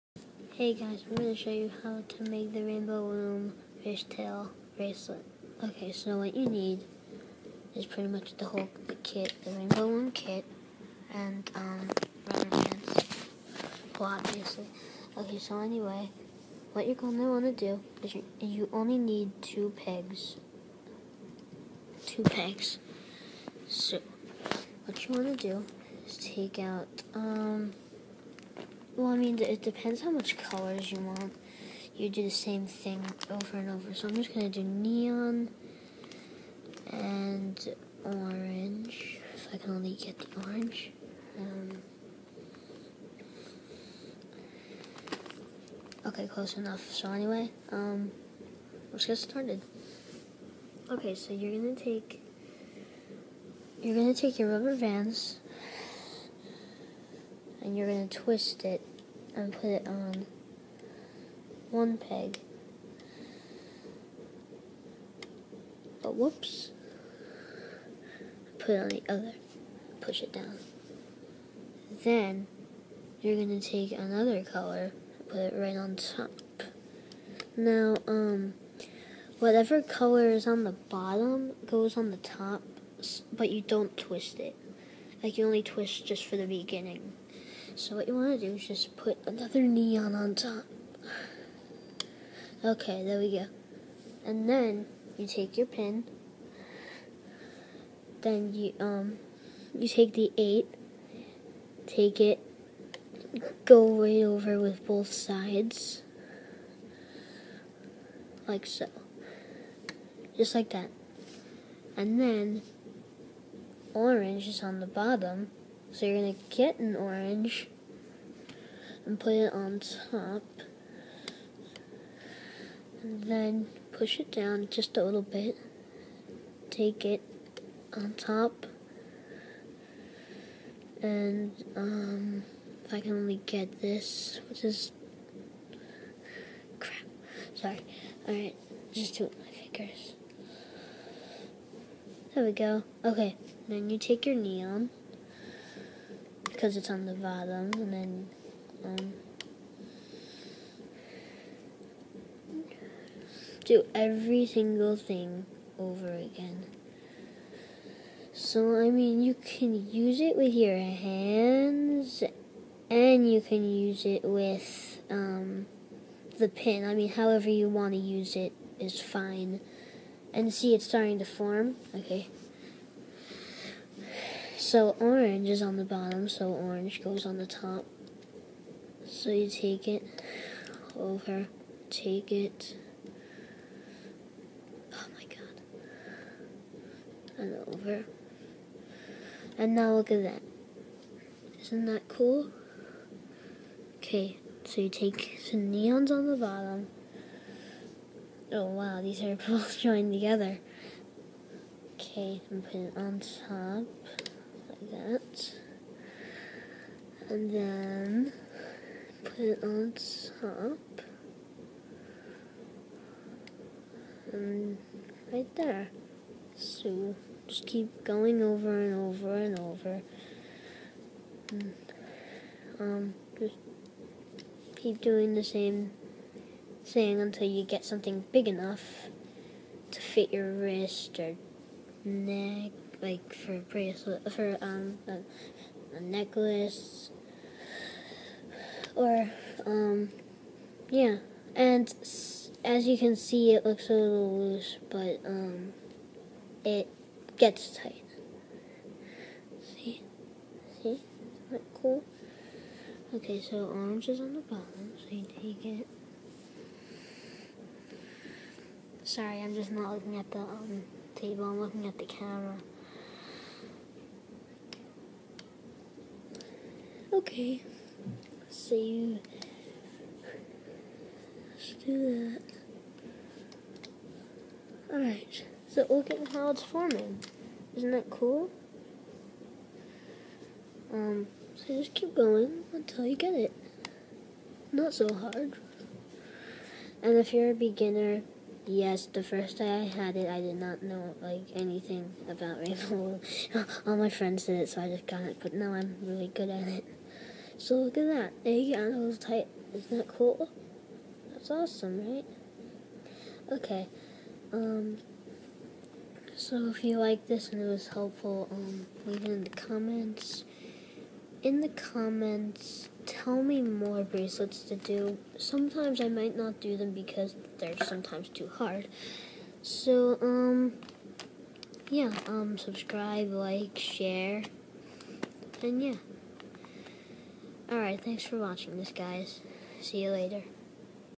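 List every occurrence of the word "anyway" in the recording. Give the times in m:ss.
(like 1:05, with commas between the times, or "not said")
0:15, 0:47.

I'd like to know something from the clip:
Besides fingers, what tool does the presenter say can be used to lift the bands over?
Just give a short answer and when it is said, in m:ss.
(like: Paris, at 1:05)
the pin, at 2:46.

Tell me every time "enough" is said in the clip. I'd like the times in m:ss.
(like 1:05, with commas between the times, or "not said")
0:46, 3:48.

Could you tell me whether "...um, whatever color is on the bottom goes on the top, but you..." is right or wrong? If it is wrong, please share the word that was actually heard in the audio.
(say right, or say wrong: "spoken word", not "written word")
right.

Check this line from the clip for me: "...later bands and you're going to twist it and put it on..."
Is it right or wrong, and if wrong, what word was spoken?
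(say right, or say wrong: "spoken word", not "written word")
wrong: "rubber", not "later".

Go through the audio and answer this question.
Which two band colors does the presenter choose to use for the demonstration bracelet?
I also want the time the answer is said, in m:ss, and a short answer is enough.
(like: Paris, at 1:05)
neon and orange, at 0:34.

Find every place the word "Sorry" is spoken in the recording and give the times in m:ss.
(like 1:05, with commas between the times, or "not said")
2:17, 4:19.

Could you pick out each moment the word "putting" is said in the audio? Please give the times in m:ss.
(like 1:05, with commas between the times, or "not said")
3:22.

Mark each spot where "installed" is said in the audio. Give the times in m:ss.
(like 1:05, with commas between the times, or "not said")
not said.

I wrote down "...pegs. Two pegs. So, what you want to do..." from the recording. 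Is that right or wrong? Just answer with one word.
right.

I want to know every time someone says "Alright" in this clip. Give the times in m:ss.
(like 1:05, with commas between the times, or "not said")
2:18, 4:34, 5:27.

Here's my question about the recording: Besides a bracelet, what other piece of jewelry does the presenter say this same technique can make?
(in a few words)
necklace.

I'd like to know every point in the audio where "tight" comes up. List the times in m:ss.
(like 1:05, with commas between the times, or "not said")
4:07, 4:59.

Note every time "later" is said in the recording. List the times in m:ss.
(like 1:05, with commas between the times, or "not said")
5:30.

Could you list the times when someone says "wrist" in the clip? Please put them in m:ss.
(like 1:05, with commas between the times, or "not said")
3:50.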